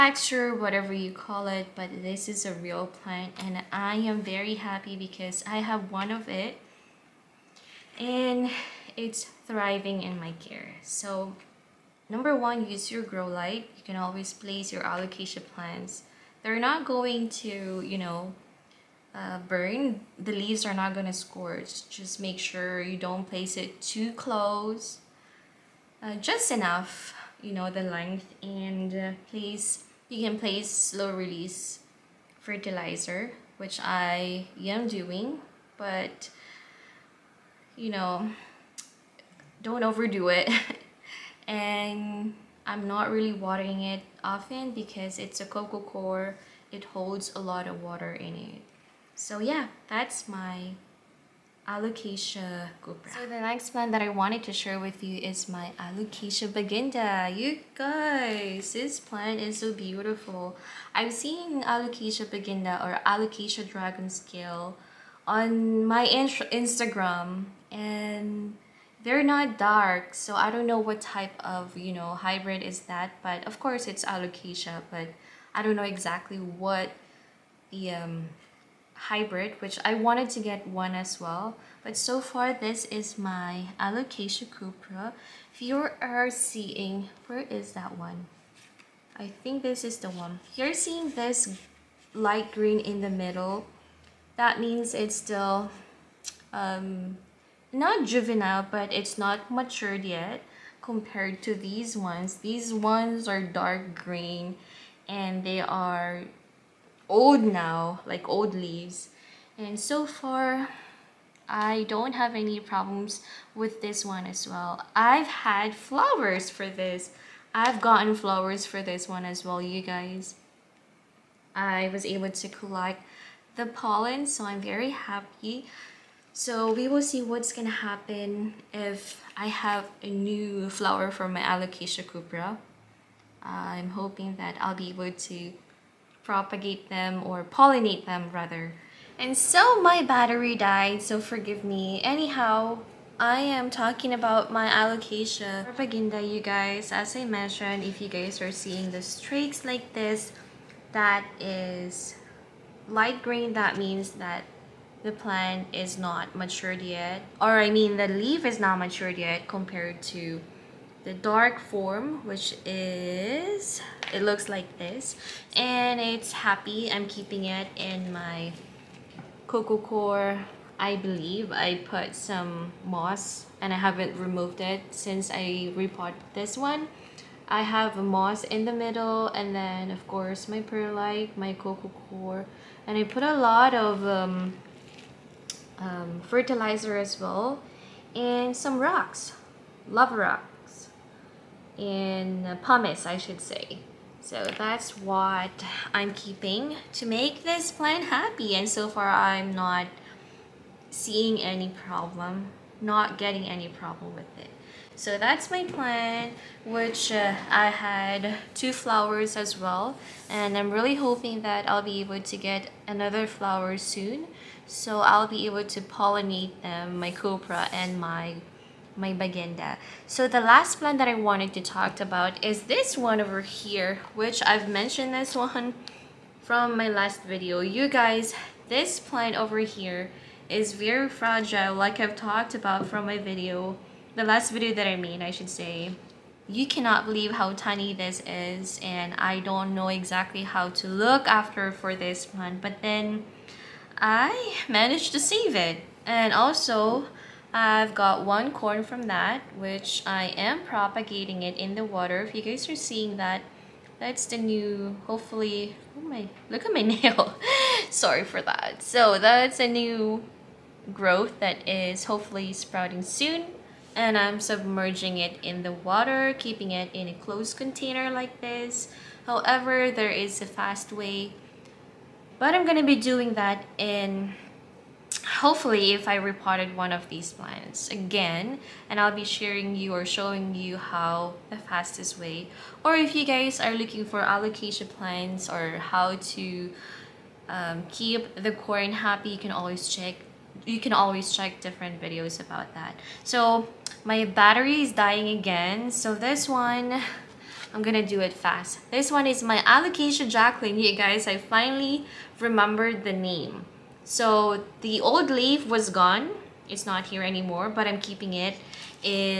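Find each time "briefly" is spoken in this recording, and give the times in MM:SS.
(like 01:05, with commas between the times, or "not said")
not said.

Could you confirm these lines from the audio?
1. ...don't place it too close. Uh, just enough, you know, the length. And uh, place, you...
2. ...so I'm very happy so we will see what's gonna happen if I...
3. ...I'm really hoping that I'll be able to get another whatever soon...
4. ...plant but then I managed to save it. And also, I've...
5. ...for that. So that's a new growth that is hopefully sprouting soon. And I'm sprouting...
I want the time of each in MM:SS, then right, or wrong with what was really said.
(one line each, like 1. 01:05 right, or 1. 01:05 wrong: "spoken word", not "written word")
1. 00:22 right
2. 02:04 right
3. 03:30 wrong: "flower", not "whatever"
4. 04:02 right
5. 04:18 wrong: "submerging", not "sprouting".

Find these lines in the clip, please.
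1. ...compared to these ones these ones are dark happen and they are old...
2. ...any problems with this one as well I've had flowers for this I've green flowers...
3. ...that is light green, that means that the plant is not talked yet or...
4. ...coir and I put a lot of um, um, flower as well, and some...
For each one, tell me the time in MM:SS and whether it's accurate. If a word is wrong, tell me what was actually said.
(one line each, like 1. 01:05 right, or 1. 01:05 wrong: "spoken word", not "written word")
1. 01:40 wrong: "green", not "happen"
2. 01:52 wrong: "gotten", not "green"
3. 02:30 wrong: "matured", not "talked"
4. 03:02 wrong: "fertilizer", not "flower".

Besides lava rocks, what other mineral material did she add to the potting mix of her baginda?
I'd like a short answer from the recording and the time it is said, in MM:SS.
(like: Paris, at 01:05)
Pumice, at 03:12.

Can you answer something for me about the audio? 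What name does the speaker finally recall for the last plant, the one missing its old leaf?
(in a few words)
Alocasia Jacklyn.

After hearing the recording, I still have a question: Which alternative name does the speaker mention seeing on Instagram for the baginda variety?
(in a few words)
Alocasia dragon scale.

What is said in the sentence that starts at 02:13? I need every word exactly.
I'm hoping that I'll be able to propagate them or pollinate them rather.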